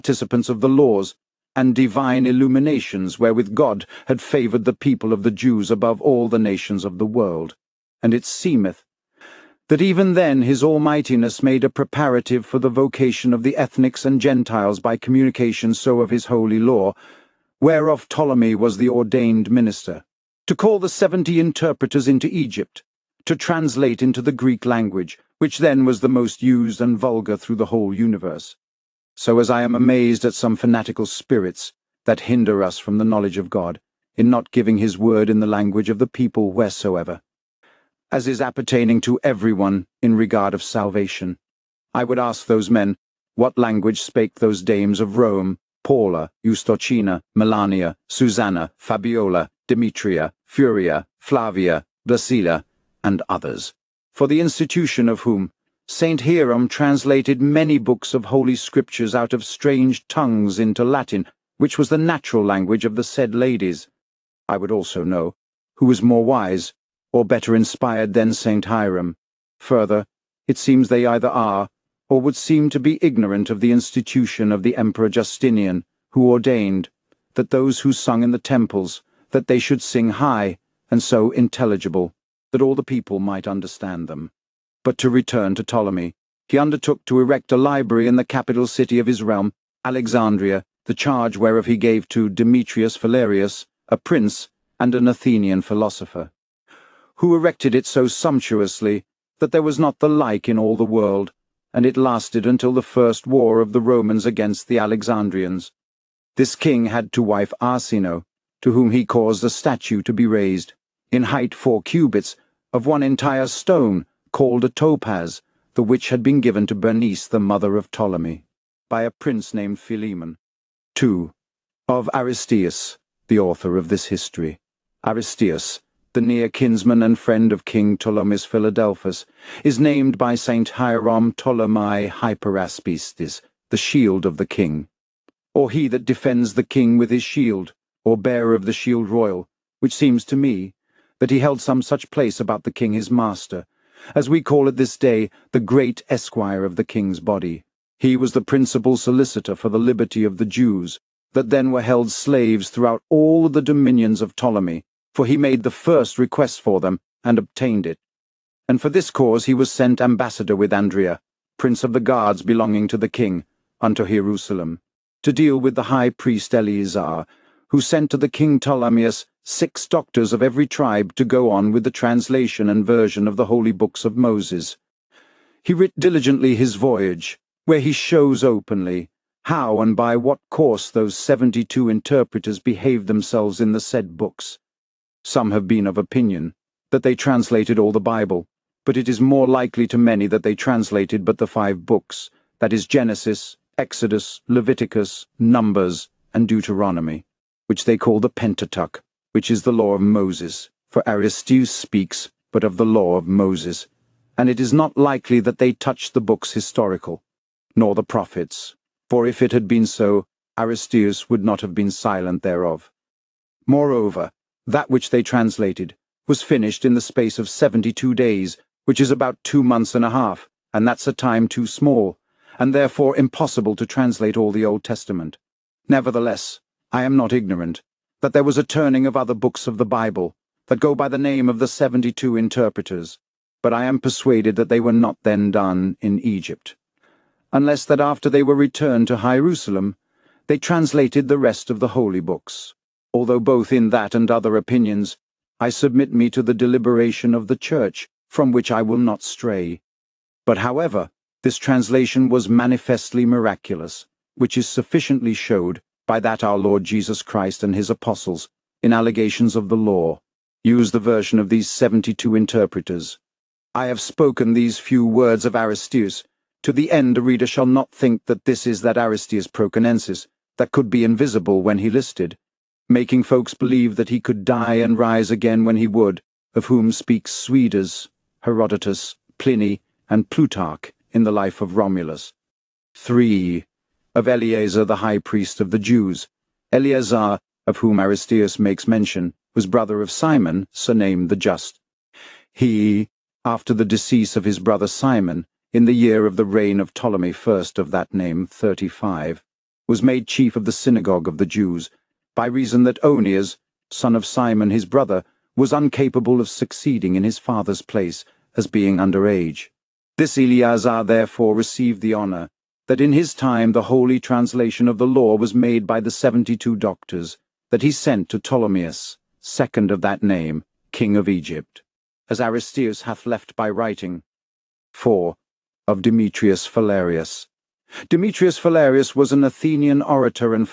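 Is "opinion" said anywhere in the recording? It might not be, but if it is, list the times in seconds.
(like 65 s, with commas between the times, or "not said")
185 s, 244 s.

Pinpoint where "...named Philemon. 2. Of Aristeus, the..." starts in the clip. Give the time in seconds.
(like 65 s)
119 s.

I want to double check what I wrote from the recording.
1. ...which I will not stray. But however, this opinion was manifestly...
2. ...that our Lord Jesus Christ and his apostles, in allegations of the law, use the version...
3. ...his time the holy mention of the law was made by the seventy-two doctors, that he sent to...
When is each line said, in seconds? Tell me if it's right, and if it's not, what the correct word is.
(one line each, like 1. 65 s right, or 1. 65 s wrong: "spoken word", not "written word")
1. 248 s wrong: "translation", not "opinion"
2. 256 s right
3. 313 s wrong: "translation", not "mention".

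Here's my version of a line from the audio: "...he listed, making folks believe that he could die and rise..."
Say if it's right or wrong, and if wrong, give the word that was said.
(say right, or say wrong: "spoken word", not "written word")
right.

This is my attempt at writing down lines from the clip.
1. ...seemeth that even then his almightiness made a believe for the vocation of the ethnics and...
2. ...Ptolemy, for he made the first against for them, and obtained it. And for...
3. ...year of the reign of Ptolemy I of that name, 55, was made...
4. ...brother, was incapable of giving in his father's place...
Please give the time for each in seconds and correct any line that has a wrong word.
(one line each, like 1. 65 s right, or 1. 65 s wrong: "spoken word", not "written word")
1. 8 s wrong: "preparative", not "believe"
2. 154 s wrong: "request", not "against"
3. 295 s wrong: "35", not "55"
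4. 304 s wrong: "succeeding", not "giving".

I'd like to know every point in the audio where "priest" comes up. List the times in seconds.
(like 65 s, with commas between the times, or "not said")
166 s, 285 s.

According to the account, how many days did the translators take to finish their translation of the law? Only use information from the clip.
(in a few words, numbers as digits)
72.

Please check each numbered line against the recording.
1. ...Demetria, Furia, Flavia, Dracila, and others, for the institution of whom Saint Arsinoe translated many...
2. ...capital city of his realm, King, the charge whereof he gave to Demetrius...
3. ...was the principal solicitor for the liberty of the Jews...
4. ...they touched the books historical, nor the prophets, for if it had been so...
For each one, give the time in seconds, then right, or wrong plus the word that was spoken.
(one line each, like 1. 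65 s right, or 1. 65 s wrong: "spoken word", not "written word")
1. 49 s wrong: "Hierom", not "Arsinoe"
2. 88 s wrong: "Alexandria", not "King"
3. 148 s right
4. 205 s right.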